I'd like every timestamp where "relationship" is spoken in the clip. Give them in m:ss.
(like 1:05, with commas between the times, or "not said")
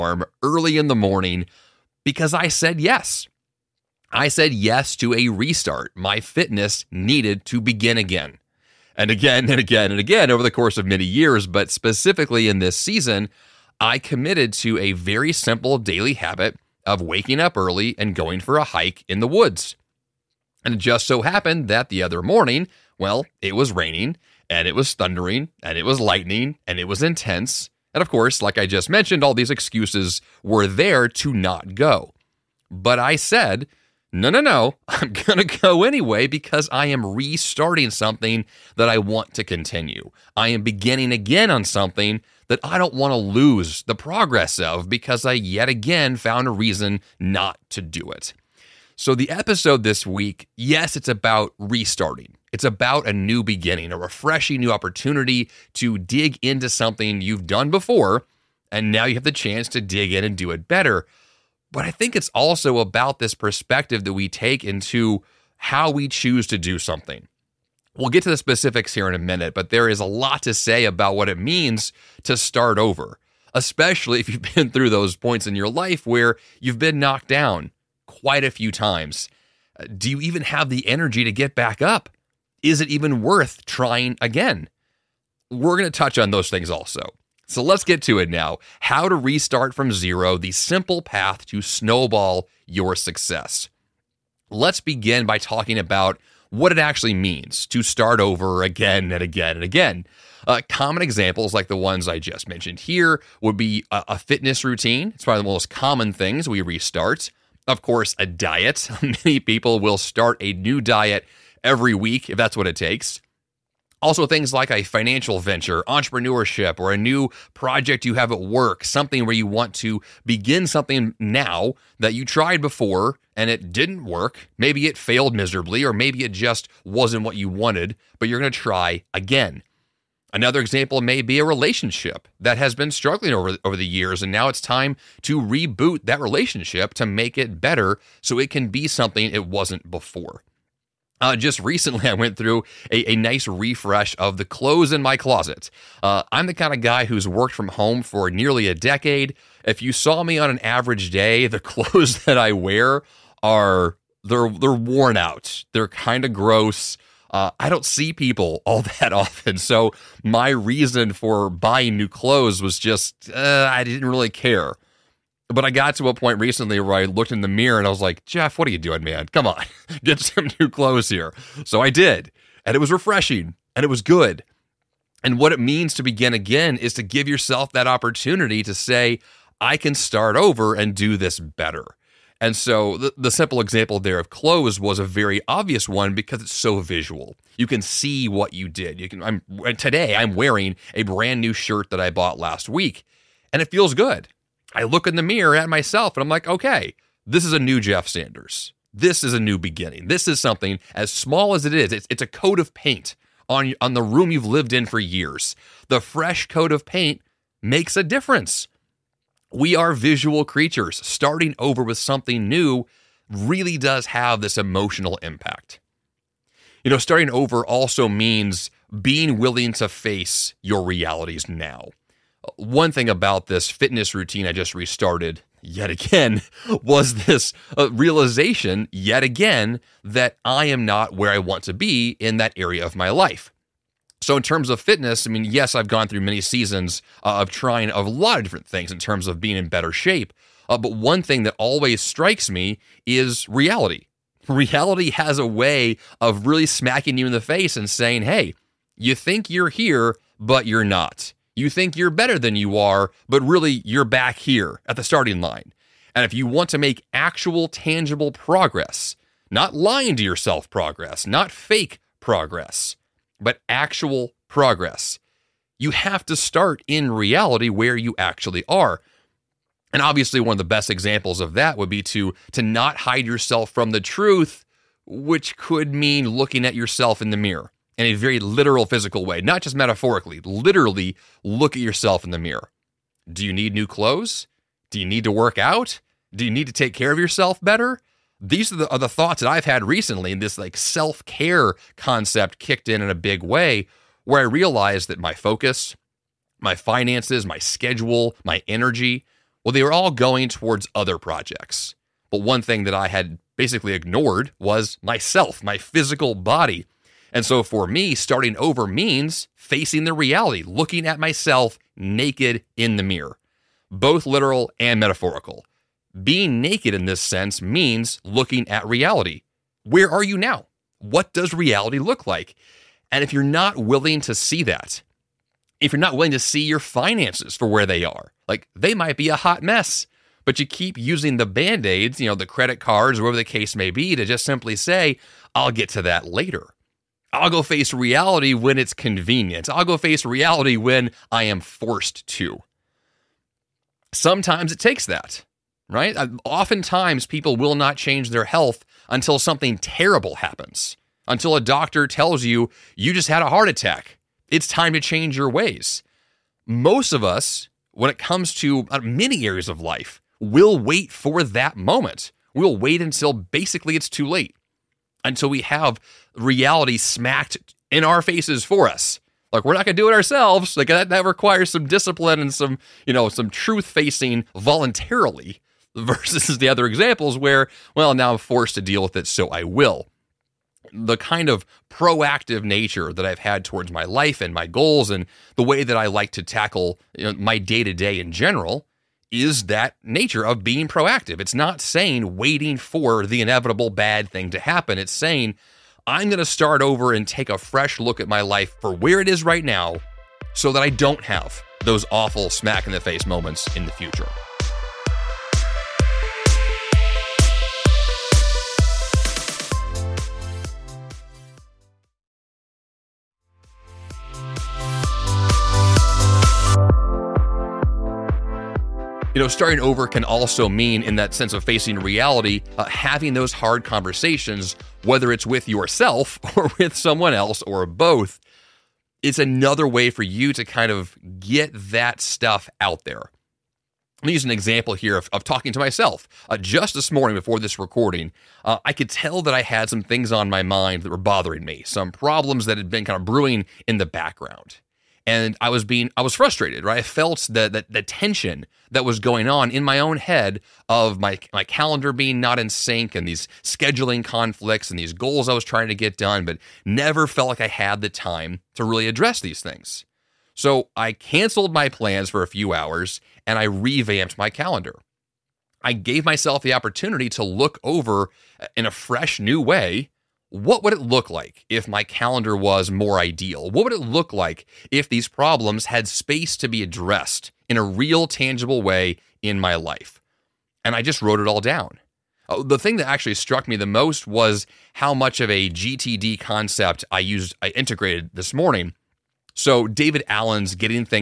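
2:11, 2:16.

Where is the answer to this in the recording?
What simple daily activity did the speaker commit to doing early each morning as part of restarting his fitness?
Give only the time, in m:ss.
0:18.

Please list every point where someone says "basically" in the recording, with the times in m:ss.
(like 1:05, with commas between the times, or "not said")
5:03, 6:03.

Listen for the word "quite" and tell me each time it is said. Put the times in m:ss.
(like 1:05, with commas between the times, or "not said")
1:18.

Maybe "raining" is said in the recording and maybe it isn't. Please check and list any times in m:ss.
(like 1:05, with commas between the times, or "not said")
0:23.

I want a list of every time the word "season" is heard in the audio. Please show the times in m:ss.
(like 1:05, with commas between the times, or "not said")
0:12, 3:56.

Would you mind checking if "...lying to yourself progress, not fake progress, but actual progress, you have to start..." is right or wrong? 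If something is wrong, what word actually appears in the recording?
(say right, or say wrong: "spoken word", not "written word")
right.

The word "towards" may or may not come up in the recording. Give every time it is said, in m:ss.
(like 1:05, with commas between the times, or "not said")
5:00, 6:23.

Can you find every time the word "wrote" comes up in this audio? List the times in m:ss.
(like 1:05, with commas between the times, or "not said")
8:01.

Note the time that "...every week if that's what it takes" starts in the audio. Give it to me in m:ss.
1:51.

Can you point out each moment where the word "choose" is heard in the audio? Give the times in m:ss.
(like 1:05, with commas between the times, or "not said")
1:06.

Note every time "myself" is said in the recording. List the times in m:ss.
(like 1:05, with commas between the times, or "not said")
3:15, 5:05, 5:11, 7:15, 7:46.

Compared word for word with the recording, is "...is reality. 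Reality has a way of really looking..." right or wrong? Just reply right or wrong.
wrong.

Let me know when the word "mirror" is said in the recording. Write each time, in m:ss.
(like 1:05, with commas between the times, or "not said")
2:47, 3:15, 4:37, 4:42, 5:13.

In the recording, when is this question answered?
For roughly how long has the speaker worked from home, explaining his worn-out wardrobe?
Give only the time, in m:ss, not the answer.
2:28.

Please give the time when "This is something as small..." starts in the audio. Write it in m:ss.
3:20.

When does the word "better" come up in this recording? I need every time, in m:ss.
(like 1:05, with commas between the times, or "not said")
1:00, 2:17, 3:01, 3:59, 4:12, 4:47.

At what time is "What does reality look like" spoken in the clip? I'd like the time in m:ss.
5:20.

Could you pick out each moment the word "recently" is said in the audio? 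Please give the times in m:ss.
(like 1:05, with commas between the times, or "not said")
2:21, 2:46, 4:49.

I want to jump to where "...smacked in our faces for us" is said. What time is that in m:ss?
6:06.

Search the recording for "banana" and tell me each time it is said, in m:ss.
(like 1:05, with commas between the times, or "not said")
not said.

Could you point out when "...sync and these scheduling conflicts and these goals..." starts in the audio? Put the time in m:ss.
7:32.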